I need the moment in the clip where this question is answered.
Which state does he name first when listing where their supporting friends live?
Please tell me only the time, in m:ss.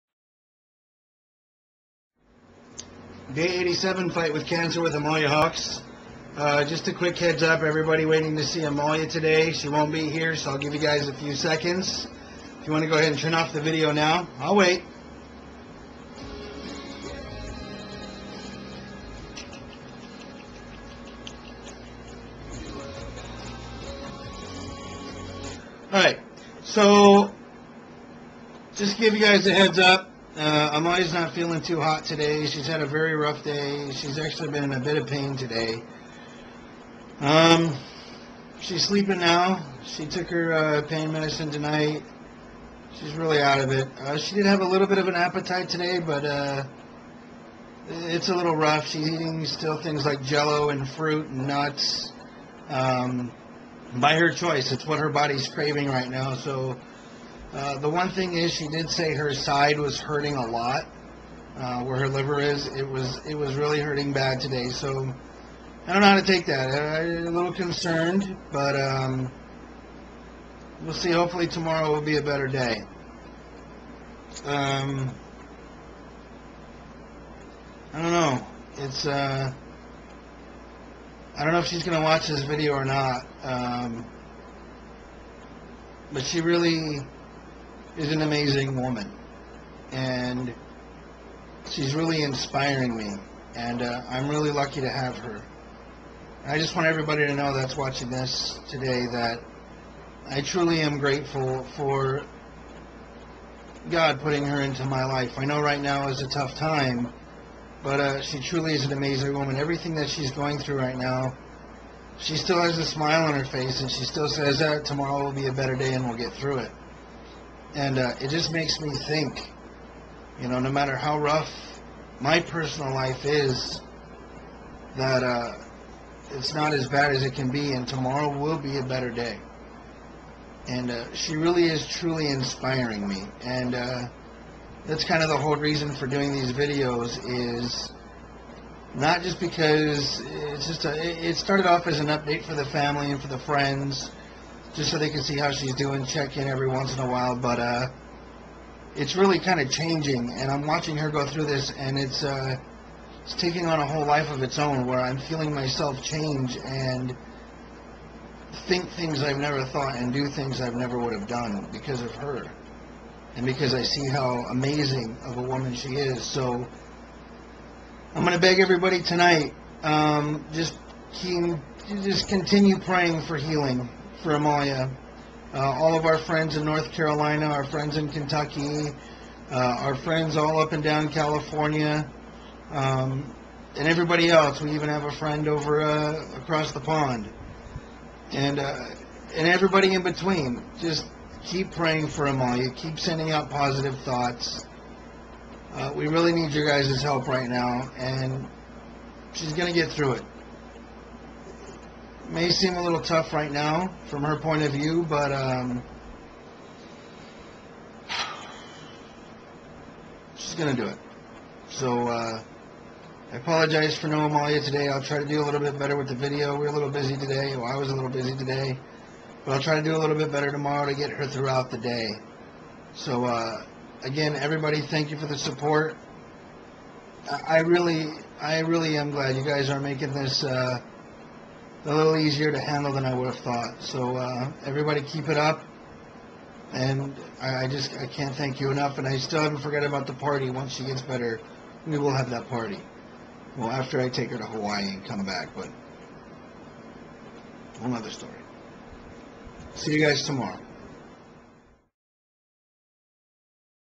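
2:56.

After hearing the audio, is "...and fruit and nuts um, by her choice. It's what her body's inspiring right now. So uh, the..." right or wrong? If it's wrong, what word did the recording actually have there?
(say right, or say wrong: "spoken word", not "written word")
wrong: "craving", not "inspiring".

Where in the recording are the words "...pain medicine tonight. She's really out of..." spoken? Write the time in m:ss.
0:40.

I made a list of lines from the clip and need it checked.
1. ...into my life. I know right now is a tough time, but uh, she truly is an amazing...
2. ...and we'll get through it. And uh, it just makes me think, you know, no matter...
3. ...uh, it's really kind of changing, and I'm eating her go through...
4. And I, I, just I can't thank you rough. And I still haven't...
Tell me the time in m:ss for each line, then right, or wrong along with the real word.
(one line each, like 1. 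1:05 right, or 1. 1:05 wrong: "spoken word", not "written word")
1. 1:44 right
2. 1:55 right
3. 2:27 wrong: "watching", not "eating"
4. 3:56 wrong: "enough", not "rough".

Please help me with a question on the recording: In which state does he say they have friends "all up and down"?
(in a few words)
California.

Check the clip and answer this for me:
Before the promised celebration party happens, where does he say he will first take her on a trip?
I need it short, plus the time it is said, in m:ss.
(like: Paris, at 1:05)
Hawaii, at 4:04.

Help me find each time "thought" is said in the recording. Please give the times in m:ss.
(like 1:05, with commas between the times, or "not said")
2:39, 3:13, 3:53.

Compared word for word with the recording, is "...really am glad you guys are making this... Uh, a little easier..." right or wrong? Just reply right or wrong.
right.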